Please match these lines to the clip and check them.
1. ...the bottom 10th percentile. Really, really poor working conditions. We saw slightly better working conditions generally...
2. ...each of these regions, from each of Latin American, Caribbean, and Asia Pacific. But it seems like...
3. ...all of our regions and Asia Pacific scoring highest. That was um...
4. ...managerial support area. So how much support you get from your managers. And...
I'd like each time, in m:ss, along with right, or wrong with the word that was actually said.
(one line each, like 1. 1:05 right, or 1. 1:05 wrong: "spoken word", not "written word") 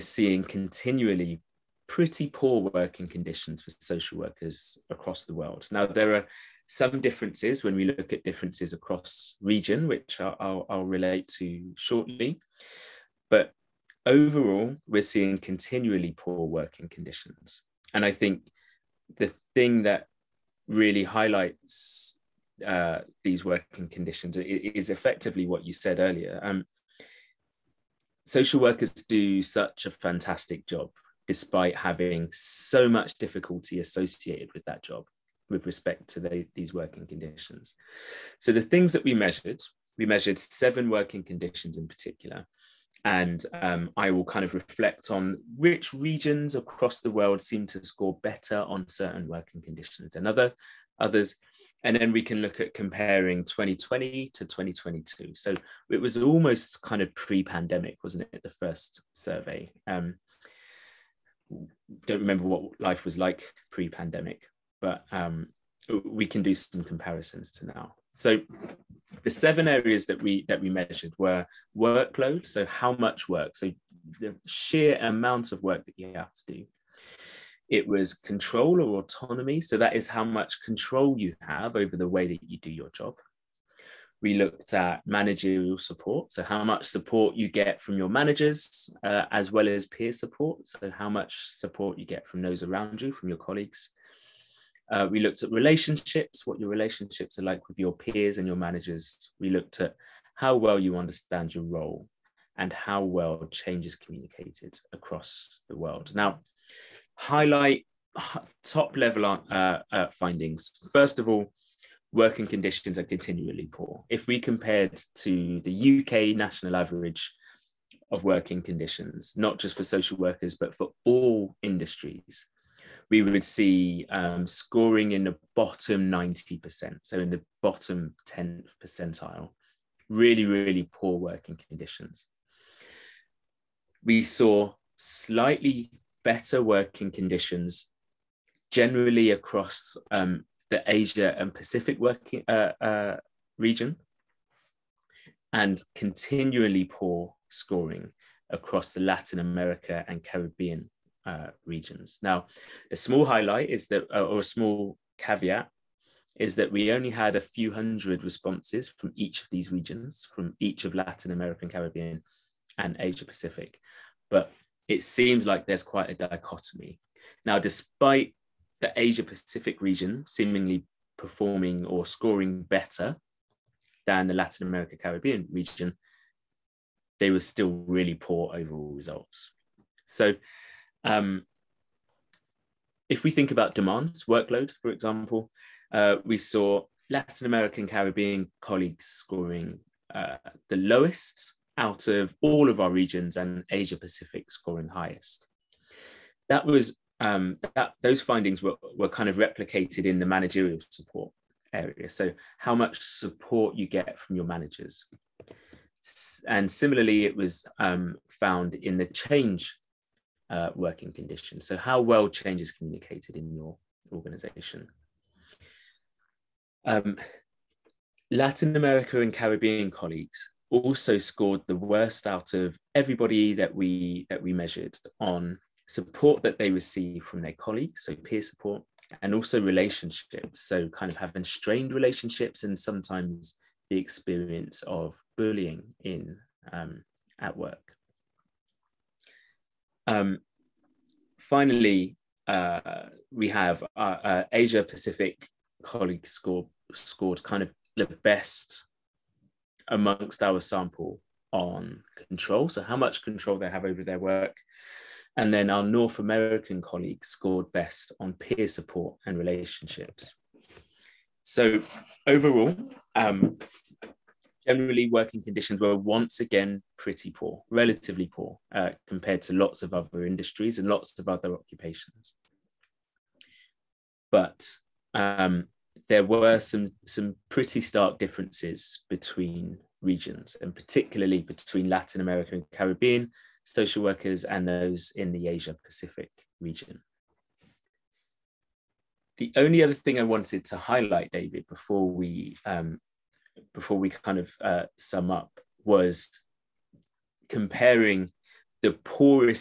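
1. 2:07 right
2. 2:39 right
3. 3:12 right
4. 3:20 right.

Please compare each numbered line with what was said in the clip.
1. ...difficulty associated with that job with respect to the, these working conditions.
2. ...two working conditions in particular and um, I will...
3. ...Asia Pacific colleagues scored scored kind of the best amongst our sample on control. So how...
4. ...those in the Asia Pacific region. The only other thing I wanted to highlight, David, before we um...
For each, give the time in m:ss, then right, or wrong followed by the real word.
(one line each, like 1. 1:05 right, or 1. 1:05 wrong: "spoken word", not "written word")
1. 0:33 right
2. 0:40 wrong: "seven", not "two"
3. 4:04 right
4. 4:44 right.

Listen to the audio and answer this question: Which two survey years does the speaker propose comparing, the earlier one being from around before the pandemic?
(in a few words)
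2020 and 2022.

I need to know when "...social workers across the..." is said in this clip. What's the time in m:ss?
0:03.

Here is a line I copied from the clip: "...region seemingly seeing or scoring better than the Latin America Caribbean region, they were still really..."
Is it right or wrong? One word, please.
wrong.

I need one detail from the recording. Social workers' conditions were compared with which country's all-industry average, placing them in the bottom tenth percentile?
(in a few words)
UK.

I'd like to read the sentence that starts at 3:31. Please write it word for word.
So how well change is communicated in your organization.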